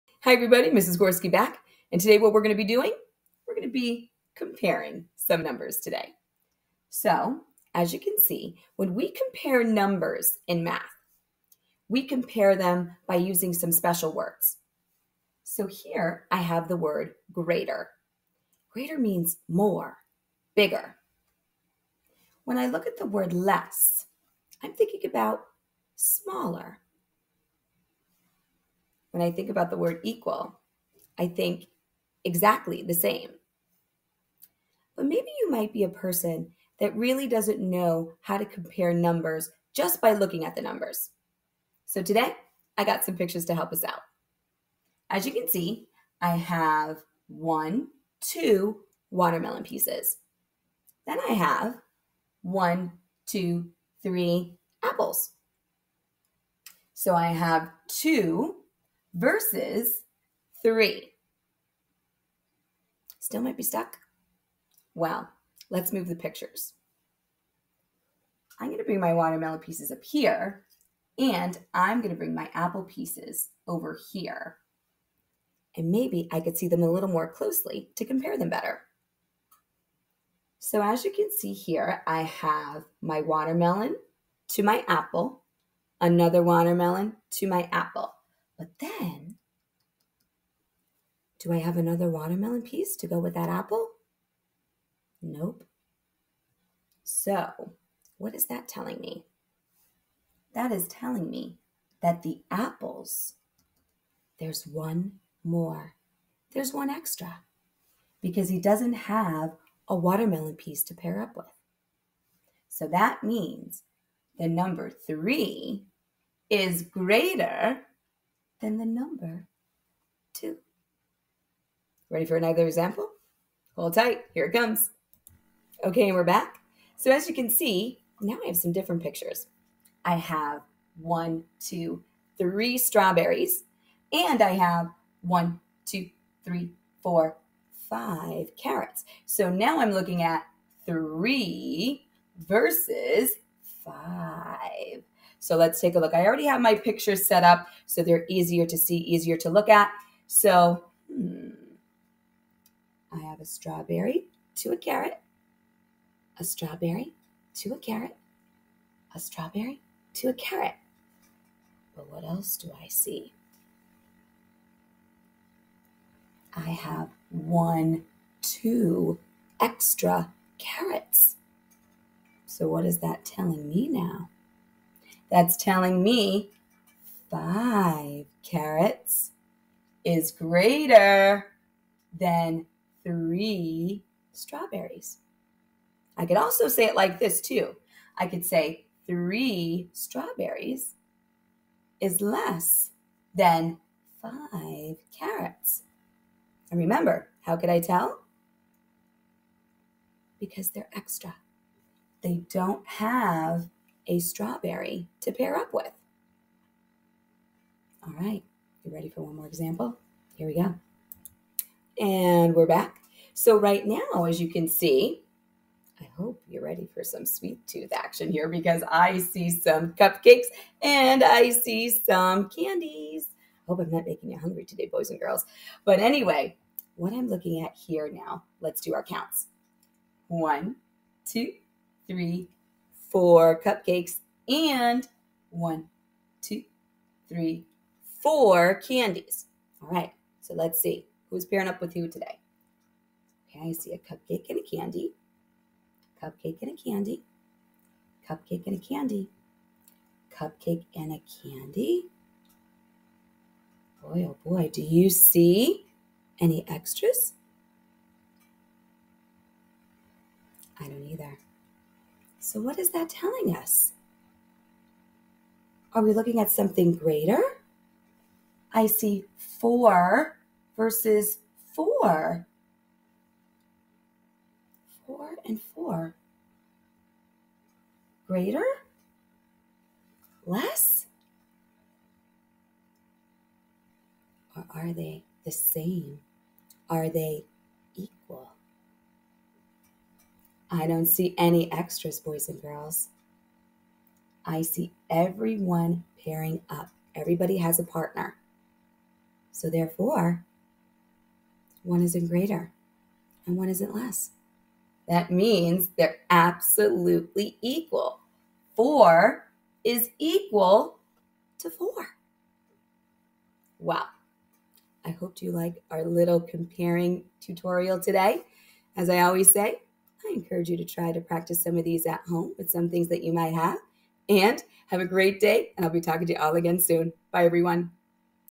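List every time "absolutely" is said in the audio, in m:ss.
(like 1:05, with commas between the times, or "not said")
5:06.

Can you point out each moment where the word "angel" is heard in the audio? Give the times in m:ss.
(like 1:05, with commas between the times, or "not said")
not said.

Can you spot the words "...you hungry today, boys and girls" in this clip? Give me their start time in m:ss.
3:44.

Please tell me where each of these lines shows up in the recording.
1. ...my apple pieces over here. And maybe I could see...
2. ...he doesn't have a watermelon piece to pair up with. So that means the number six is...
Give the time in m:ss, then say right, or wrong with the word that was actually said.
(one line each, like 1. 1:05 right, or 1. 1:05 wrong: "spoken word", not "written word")
1. 1:12 right
2. 1:48 wrong: "three", not "six".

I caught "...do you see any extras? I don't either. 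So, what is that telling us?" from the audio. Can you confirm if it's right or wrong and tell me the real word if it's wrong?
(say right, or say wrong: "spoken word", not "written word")
right.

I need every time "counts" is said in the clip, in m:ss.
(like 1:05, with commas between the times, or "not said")
3:49.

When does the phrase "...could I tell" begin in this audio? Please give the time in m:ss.
3:17.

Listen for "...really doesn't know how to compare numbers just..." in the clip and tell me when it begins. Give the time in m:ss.
0:36.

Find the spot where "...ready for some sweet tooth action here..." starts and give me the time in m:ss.
3:36.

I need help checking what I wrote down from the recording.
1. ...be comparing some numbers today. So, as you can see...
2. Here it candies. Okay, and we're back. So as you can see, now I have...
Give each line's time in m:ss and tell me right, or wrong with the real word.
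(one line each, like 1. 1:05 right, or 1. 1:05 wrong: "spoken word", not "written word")
1. 0:03 right
2. 2:04 wrong: "comes", not "candies".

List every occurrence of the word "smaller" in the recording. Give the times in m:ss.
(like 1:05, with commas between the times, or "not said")
0:25.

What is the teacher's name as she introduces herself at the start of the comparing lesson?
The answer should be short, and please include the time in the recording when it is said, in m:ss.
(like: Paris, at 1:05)
Mrs. Gorski, at 0:00.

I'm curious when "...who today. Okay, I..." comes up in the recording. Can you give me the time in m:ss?
4:01.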